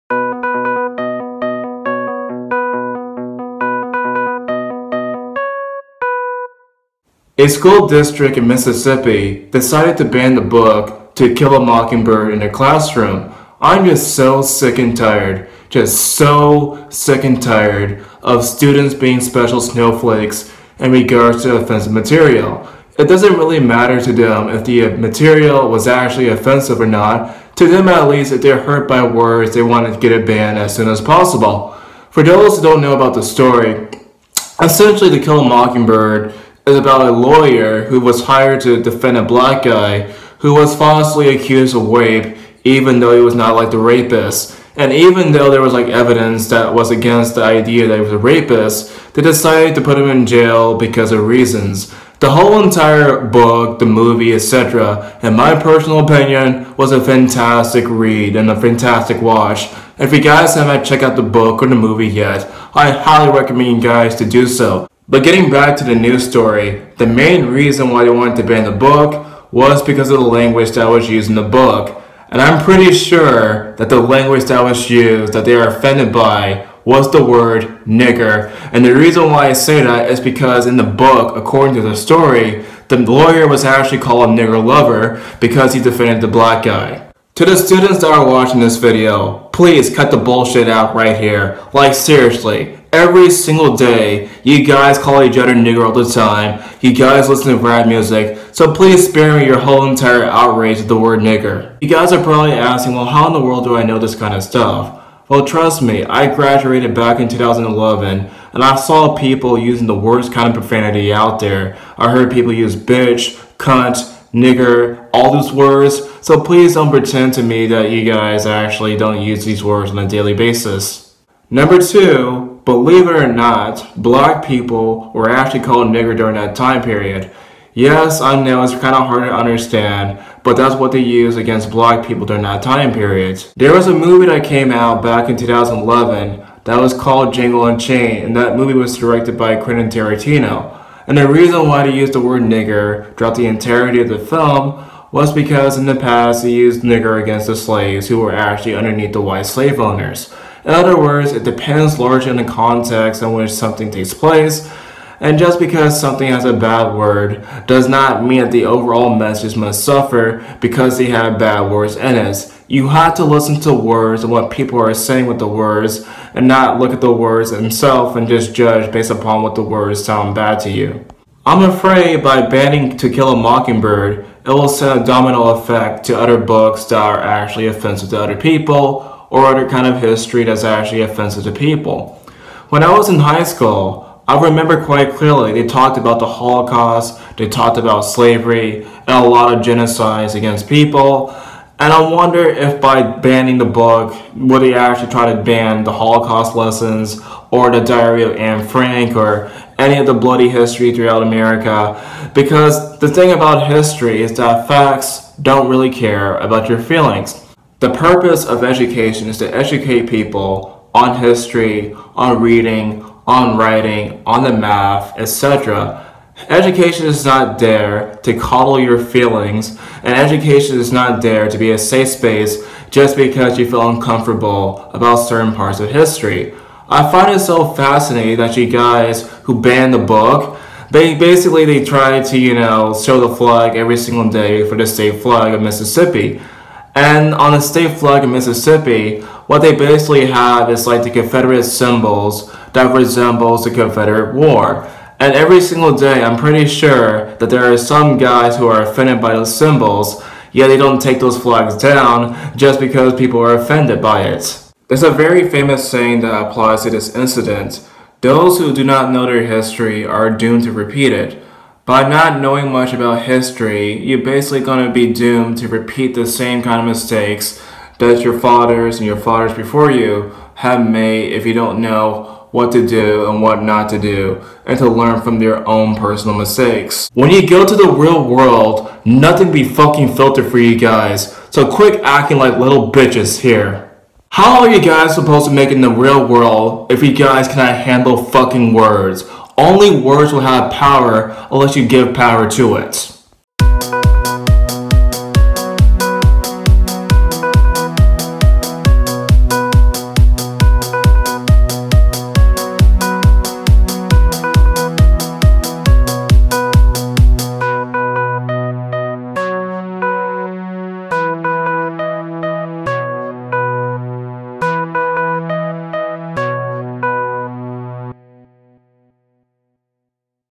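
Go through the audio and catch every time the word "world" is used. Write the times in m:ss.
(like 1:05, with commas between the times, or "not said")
1:43, 4:38, 4:46.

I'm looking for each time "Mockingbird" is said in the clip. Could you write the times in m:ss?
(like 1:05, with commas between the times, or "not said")
0:11, 0:35, 2:53.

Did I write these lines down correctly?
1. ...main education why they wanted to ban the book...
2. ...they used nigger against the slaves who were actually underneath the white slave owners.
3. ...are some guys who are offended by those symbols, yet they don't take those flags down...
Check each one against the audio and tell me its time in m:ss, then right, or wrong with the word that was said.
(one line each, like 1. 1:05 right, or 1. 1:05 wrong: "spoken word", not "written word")
1. 1:07 wrong: "reason", not "education"
2. 2:26 right
3. 4:07 right.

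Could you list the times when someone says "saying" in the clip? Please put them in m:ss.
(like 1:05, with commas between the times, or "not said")
2:44, 4:15.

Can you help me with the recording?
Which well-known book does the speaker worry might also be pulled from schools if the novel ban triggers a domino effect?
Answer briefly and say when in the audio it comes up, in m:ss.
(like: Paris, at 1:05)
The Diary of Anne Frank, at 3:17.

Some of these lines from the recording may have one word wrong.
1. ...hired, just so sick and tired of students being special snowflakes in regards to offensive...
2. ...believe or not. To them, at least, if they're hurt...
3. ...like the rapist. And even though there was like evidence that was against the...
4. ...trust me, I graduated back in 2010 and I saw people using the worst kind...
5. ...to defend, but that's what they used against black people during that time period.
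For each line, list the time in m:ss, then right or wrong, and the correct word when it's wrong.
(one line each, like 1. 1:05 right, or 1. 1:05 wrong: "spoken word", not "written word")
1. 0:14 wrong: "tired", not "hired"
2. 0:26 wrong: "offensive", not "believe"
3. 0:43 right
4. 1:45 wrong: "2011", not "2010"
5. 2:09 wrong: "understand", not "defend".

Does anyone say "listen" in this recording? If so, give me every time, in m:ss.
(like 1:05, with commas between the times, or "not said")
1:37, 2:43.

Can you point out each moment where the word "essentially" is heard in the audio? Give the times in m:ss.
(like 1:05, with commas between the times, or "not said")
0:34.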